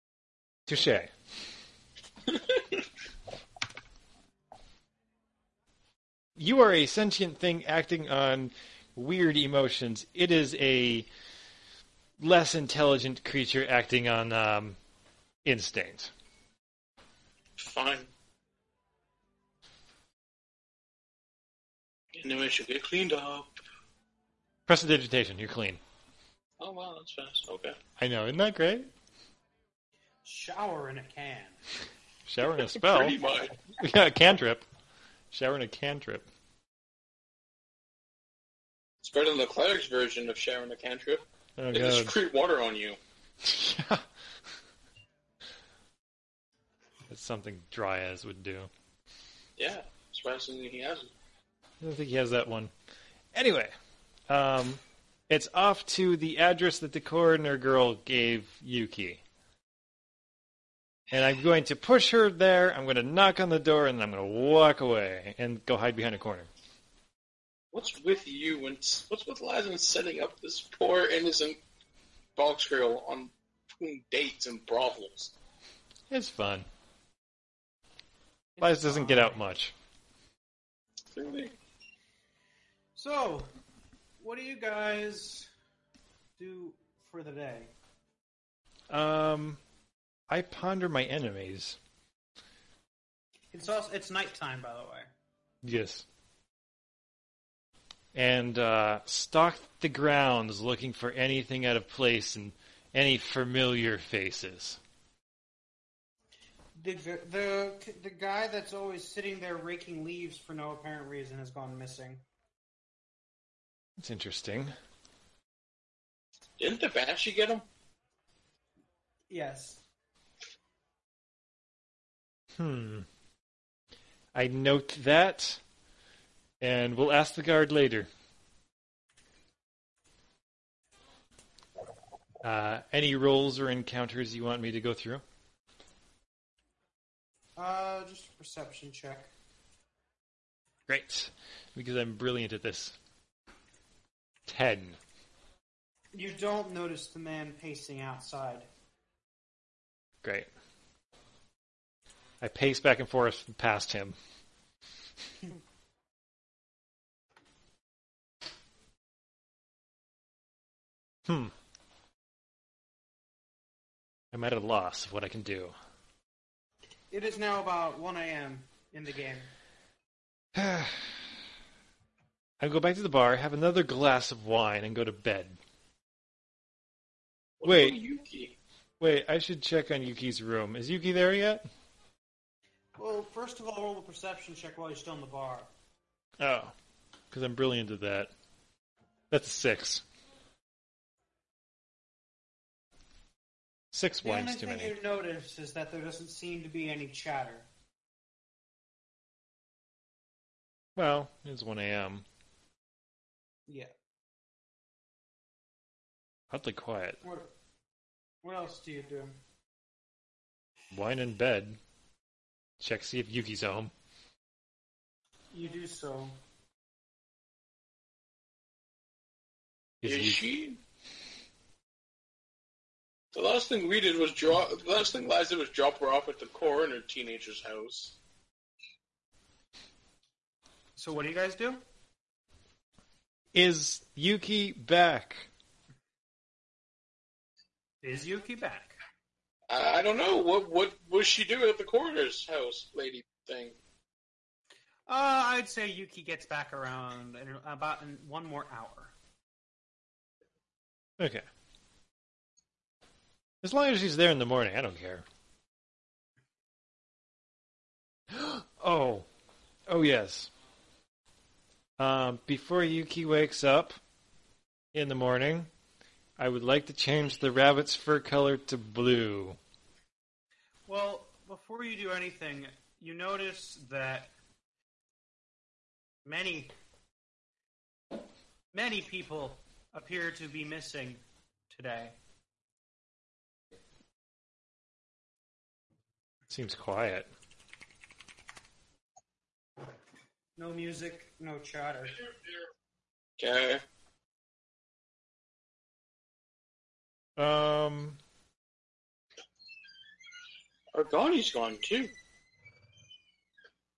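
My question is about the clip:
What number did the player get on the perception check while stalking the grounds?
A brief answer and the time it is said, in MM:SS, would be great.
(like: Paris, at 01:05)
10, at 02:24.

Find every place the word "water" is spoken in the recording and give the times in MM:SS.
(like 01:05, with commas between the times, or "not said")
00:42.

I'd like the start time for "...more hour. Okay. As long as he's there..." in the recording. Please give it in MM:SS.
04:08.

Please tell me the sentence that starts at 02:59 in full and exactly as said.
wait, I should check on Yuki's room.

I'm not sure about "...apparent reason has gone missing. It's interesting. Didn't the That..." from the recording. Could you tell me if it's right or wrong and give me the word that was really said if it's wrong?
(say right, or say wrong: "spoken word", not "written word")
wrong: "Banshee", not "That".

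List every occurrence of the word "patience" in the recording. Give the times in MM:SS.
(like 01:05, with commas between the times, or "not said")
not said.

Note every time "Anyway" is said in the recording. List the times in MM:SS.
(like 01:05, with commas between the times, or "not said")
00:53.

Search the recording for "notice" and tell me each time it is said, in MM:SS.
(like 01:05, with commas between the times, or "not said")
02:26, 03:15, 04:33.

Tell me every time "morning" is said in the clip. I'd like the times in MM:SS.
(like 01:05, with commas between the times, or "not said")
04:14, 04:25.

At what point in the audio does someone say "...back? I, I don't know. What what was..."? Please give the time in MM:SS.
03:58.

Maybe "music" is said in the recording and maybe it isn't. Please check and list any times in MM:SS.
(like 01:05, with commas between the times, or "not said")
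04:50.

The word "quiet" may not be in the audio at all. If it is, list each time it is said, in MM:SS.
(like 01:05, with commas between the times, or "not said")
03:26, 04:46.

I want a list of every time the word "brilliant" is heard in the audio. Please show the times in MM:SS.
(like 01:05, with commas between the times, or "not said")
02:22, 03:07.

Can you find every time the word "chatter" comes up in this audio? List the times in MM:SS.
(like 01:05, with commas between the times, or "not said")
03:17, 04:51.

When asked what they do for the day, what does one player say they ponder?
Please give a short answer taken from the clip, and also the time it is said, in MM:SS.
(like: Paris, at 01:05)
My enemies, at 01:30.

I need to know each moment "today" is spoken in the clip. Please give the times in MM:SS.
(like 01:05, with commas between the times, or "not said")
04:41.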